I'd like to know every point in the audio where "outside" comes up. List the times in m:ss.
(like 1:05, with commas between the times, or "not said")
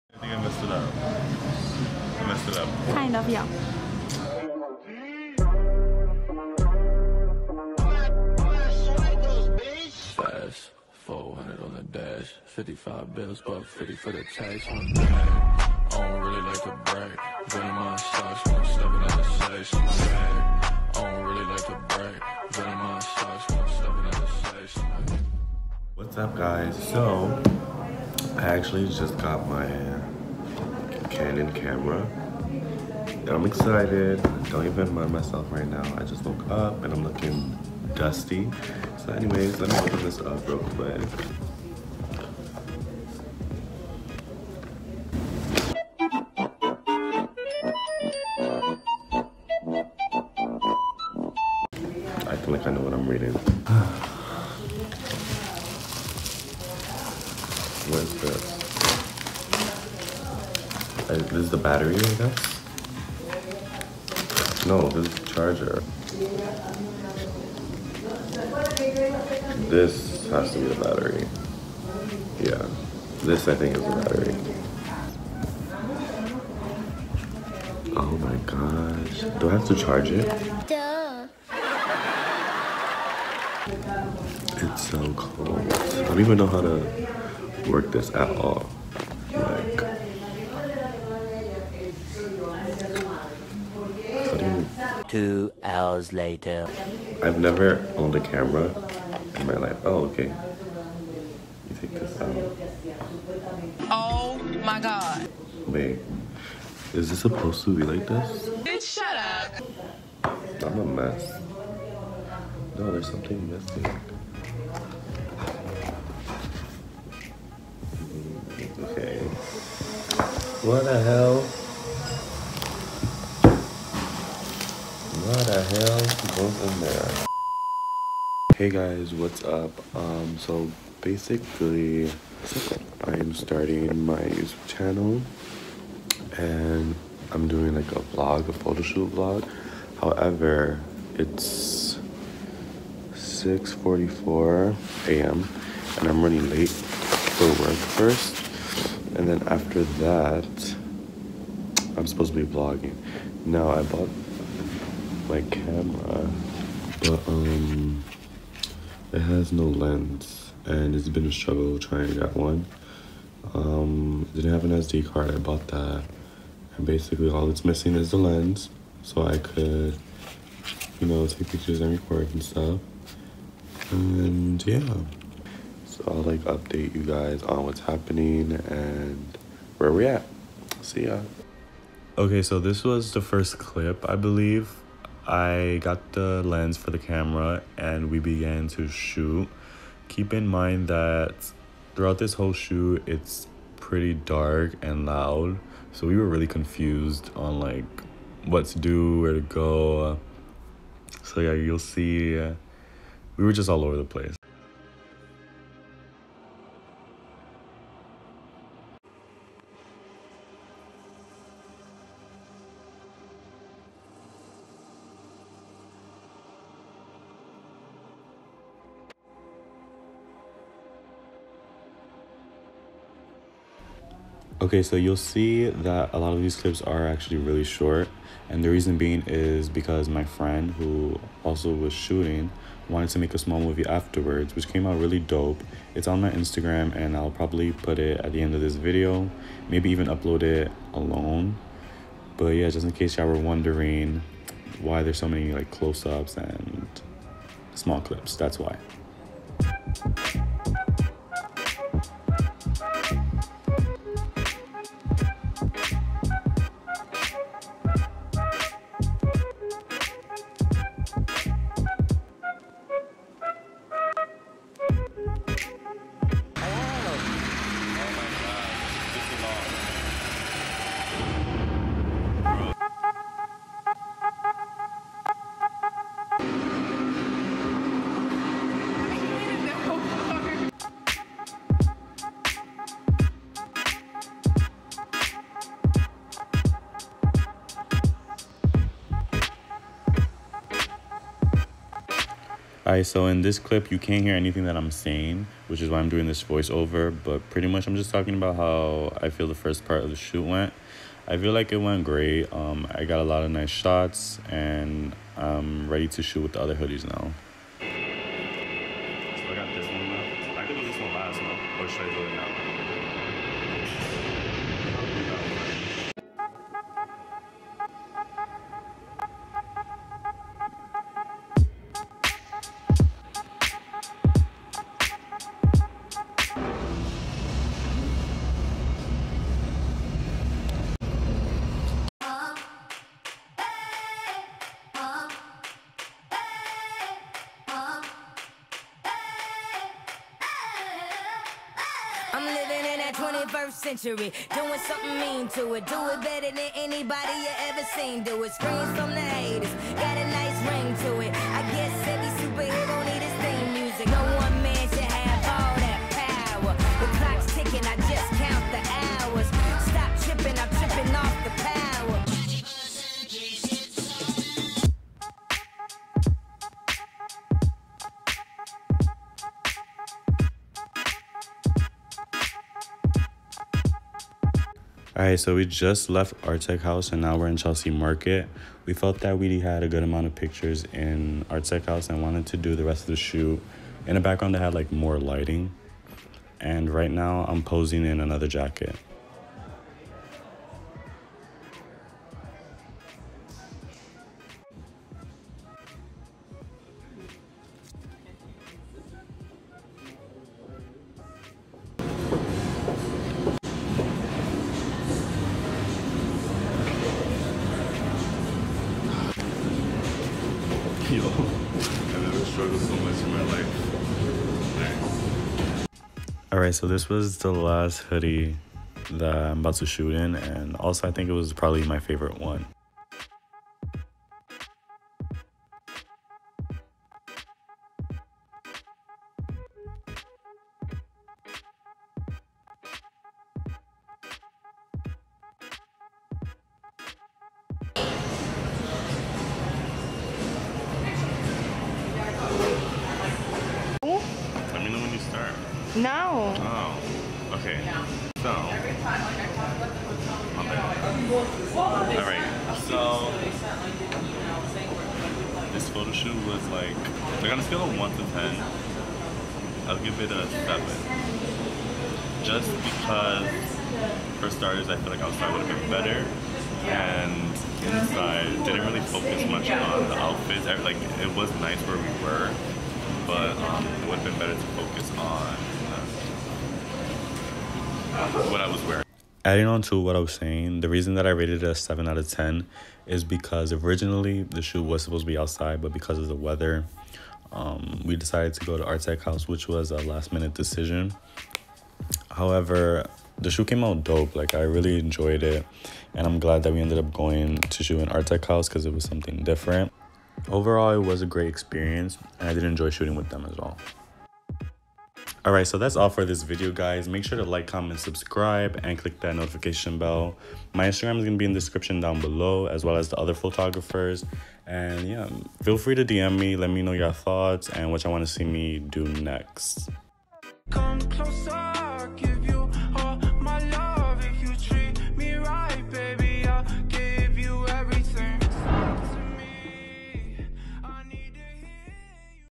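7:45, 8:05.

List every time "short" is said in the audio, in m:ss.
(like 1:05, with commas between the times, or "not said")
3:47.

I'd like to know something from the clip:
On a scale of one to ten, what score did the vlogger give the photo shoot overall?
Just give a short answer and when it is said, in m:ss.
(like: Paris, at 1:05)
7, at 7:40.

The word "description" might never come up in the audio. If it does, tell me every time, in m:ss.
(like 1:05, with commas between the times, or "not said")
8:31.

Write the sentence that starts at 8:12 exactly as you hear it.
However, the shoe came out dope.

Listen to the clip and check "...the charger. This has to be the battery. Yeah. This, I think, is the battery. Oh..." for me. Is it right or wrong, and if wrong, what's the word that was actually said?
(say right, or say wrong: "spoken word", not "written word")
right.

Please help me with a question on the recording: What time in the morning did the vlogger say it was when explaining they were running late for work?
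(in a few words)
6:44 a.m.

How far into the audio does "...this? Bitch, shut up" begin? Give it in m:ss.
1:48.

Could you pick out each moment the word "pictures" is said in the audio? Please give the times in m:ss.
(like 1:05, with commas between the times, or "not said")
2:51, 6:20.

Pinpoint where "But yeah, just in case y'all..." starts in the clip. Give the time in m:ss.
4:02.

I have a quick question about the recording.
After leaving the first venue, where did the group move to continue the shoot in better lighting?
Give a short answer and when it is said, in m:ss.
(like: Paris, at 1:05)
Chelsea Market, at 6:17.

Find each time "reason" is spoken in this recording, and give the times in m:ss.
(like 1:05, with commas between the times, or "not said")
3:48, 8:00.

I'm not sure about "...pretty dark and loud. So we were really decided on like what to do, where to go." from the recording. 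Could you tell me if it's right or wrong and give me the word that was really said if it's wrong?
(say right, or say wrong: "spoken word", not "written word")
wrong: "confused", not "decided".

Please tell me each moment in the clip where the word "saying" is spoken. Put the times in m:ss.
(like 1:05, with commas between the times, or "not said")
4:54, 8:00.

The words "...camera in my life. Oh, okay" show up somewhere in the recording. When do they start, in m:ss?
1:38.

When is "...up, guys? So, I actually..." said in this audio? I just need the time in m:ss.
0:26.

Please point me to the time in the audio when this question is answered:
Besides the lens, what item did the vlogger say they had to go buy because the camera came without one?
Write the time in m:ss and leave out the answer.
2:44.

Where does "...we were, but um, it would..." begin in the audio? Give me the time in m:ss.
7:51.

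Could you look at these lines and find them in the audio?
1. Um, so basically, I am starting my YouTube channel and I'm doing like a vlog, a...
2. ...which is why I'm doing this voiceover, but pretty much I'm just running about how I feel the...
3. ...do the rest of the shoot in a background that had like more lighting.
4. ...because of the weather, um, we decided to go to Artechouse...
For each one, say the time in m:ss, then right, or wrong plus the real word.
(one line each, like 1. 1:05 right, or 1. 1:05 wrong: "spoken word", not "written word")
1. 2:09 right
2. 4:55 wrong: "talking", not "running"
3. 6:22 right
4. 8:05 right.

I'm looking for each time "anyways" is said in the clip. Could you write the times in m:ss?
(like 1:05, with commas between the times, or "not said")
0:39.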